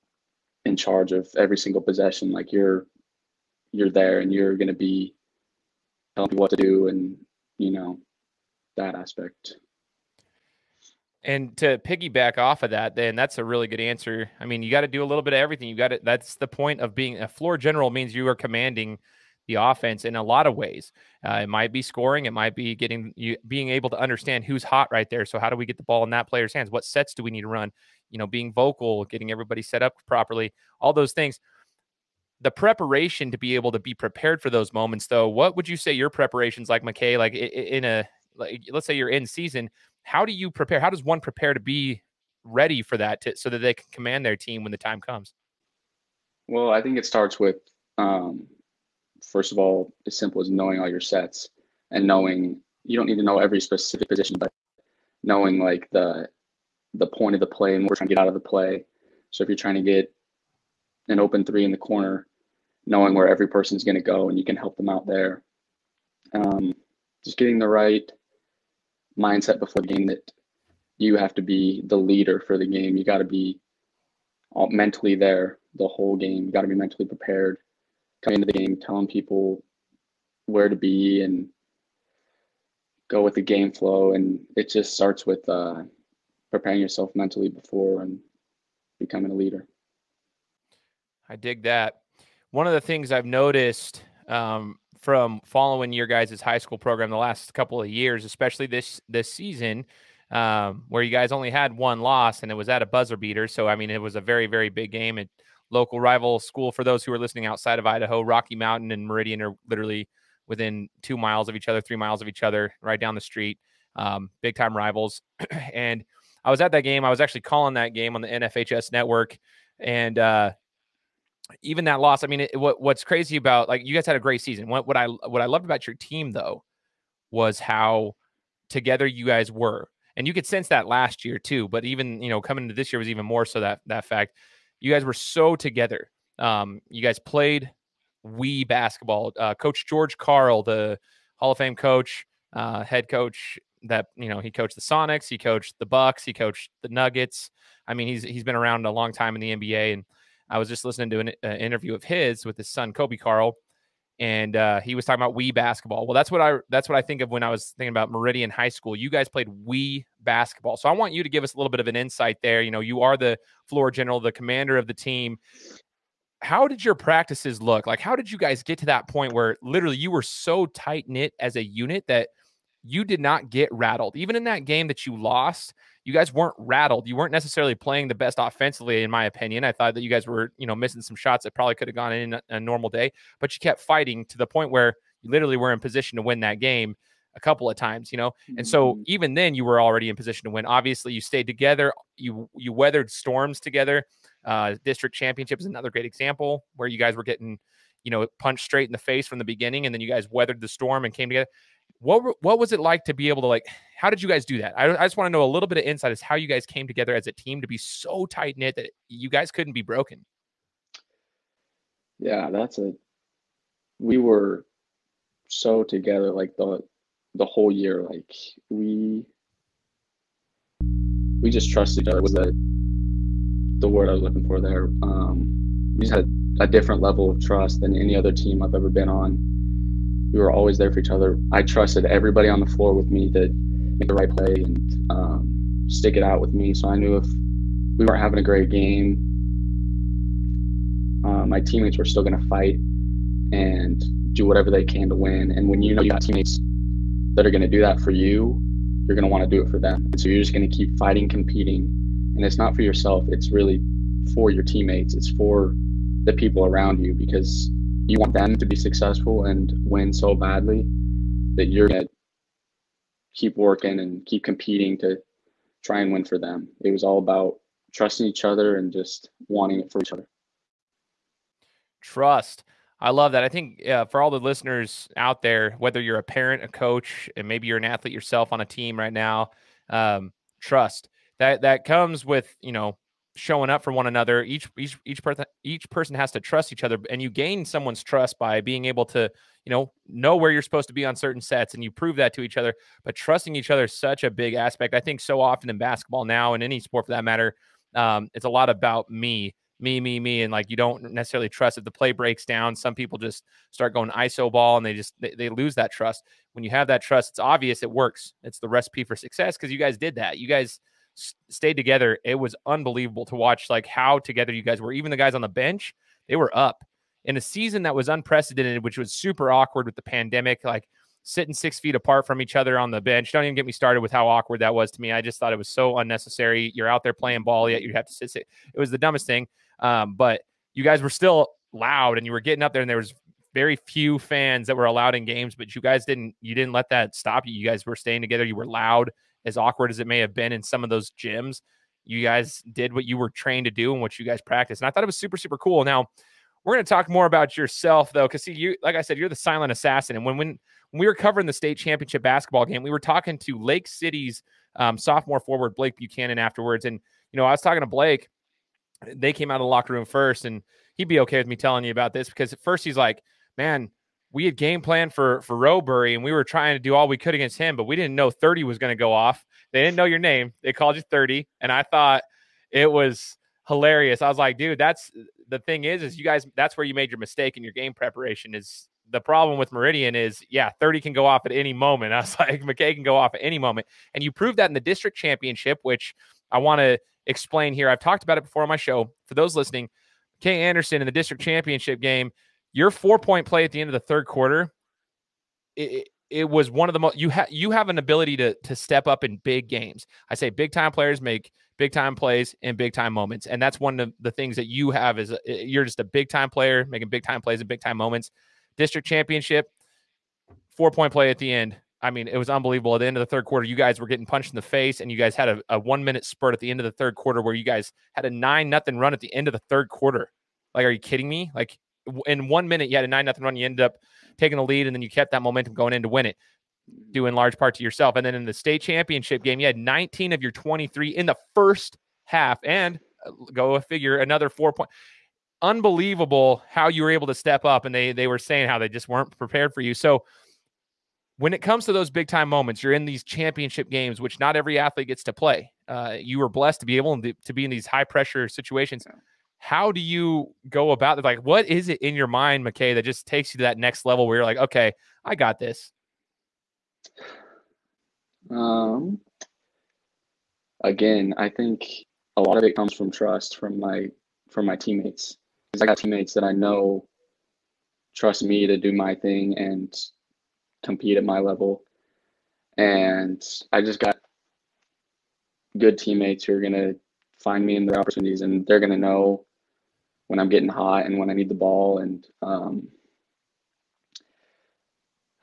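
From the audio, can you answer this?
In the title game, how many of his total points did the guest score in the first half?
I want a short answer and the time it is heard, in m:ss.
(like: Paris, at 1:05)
19, at 7:09.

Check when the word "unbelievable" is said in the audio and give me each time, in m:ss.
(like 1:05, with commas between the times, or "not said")
5:12, 6:52, 7:15.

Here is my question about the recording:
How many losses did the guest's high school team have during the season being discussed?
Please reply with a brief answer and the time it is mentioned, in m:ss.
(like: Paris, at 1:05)
1, at 1:41.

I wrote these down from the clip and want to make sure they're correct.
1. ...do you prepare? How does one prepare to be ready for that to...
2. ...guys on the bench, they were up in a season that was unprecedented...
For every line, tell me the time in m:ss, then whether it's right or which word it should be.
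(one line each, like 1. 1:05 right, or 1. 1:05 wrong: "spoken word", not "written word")
1. 0:40 right
2. 5:15 right.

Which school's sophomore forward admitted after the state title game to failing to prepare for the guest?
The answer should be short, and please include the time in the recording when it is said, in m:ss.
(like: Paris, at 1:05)
Lake City, at 5:53.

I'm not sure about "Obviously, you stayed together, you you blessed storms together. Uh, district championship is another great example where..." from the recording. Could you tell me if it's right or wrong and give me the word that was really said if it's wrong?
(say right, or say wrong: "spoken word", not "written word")
wrong: "weathered", not "blessed".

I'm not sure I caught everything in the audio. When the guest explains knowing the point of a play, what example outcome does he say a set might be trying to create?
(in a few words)
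open three in the corner.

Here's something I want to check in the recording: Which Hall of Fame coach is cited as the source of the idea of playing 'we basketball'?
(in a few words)
George Karl.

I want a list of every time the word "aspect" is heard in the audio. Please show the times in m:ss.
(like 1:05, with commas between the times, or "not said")
0:08, 4:54.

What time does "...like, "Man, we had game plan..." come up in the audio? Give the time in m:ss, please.
6:02.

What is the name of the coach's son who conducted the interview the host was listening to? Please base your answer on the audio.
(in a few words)
Coby Karl.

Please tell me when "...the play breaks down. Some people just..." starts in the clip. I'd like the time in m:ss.
5:01.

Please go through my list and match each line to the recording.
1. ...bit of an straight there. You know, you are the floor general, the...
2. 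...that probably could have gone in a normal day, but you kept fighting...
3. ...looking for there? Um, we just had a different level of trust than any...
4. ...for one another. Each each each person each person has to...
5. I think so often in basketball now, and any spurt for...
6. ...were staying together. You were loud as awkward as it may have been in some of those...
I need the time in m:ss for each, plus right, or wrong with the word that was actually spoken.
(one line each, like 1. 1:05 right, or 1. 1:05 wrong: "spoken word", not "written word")
1. 2:41 wrong: "insight", not "straight"
2. 3:01 right
3. 3:44 right
4. 4:43 right
5. 4:54 wrong: "sport", not "spurt"
6. 5:37 right.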